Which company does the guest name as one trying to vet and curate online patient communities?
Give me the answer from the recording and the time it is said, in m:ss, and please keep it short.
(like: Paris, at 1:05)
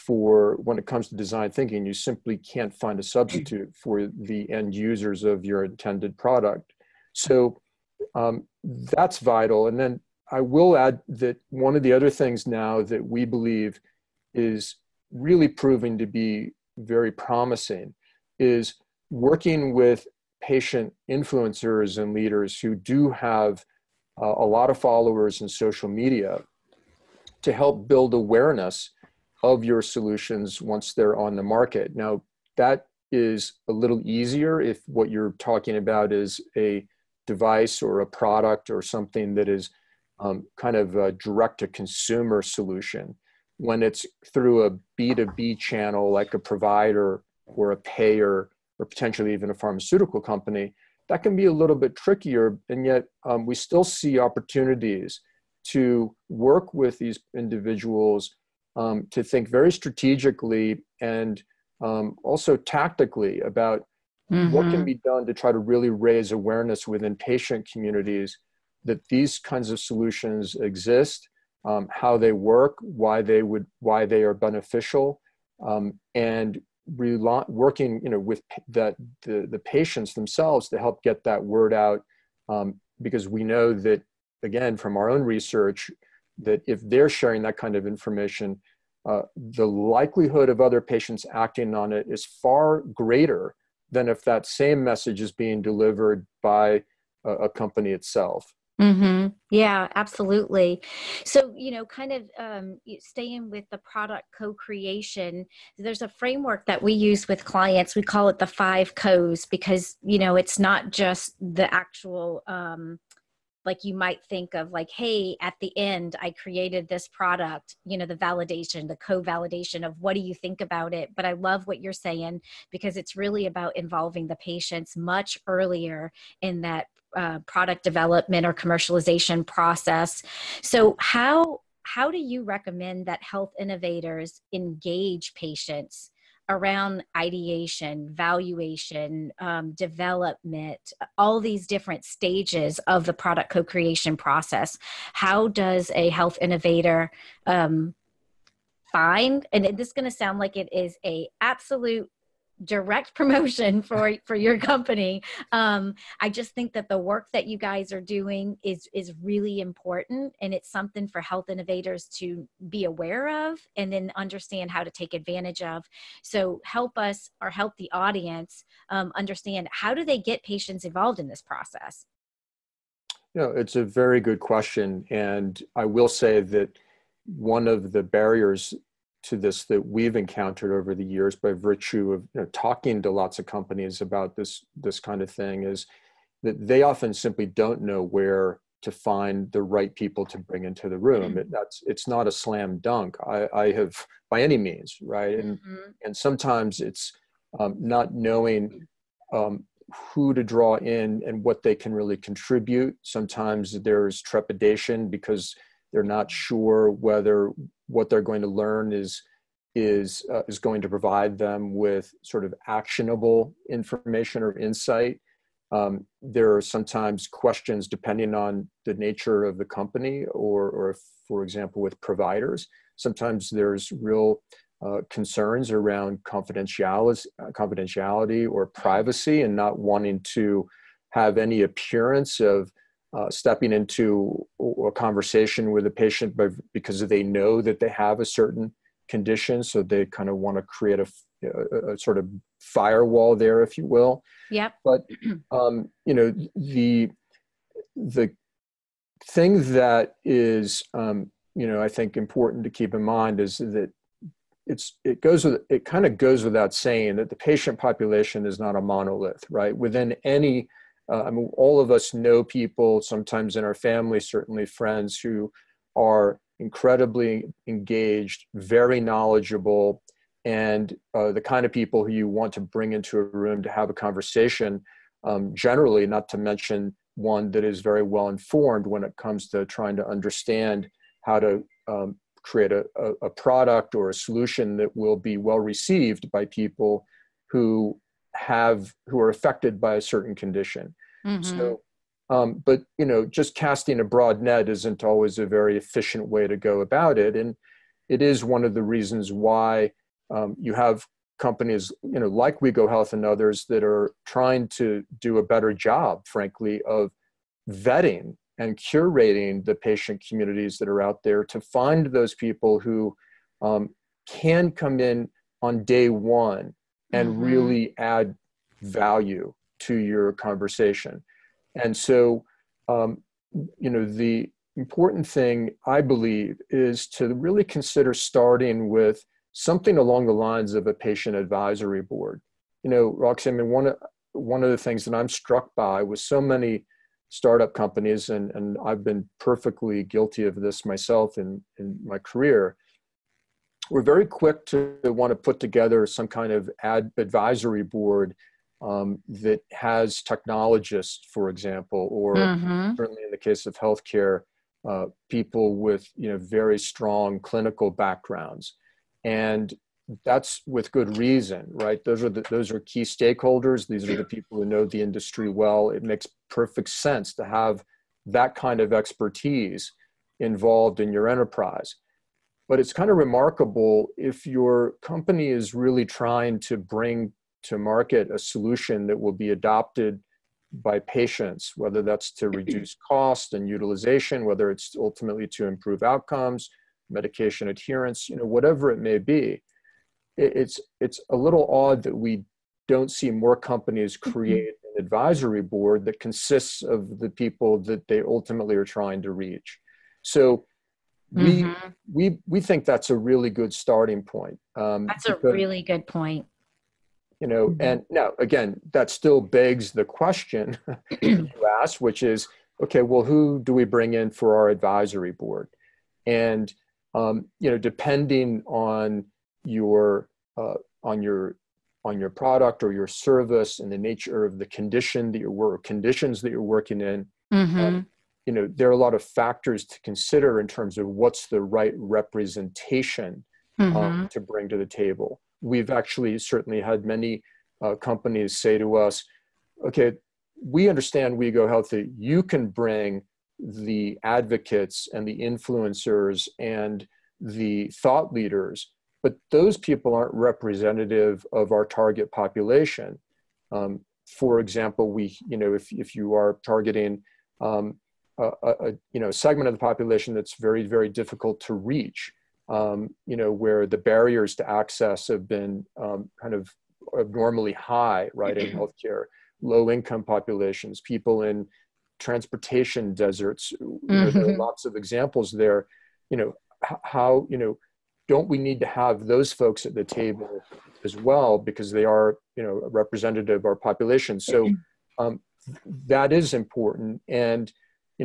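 WeGo Health, at 5:02.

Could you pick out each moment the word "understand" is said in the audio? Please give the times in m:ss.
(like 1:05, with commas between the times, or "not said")
2:44, 2:49, 4:40, 7:20.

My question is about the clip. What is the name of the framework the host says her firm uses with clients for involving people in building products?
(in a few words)
The five co's.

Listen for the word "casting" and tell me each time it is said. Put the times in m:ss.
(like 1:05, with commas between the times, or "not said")
4:53.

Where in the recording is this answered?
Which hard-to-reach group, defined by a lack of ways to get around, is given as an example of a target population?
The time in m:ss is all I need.
7:51.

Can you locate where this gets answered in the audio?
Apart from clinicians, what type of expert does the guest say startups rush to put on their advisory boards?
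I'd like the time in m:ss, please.
5:50.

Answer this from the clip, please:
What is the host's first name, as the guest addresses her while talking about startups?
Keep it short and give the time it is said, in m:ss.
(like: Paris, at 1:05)
Roxanne, at 5:33.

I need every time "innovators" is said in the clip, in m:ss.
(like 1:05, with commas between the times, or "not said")
2:13, 2:26, 2:41.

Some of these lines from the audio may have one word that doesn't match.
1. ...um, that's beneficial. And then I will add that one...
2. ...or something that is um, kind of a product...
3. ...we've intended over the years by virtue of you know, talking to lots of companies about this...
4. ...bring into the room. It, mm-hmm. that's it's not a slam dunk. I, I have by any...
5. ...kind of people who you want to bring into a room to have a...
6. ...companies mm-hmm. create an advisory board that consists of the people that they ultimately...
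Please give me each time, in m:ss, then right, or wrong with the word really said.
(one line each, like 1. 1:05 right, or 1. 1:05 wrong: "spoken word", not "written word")
1. 0:08 wrong: "vital", not "beneficial"
2. 0:38 wrong: "direct", not "product"
3. 2:59 wrong: "encountered", not "intended"
4. 3:10 right
5. 4:31 right
6. 6:33 right.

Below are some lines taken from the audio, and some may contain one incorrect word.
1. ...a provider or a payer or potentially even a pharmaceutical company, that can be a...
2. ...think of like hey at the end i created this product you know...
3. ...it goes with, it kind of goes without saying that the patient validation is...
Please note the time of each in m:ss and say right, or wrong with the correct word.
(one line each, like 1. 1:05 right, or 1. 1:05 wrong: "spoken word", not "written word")
1. 0:46 right
2. 1:54 right
3. 4:15 wrong: "population", not "validation".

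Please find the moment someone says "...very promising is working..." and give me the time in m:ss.
0:16.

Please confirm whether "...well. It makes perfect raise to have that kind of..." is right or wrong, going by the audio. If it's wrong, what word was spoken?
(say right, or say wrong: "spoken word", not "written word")
wrong: "sense", not "raise".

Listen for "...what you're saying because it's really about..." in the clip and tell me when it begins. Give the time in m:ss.
2:01.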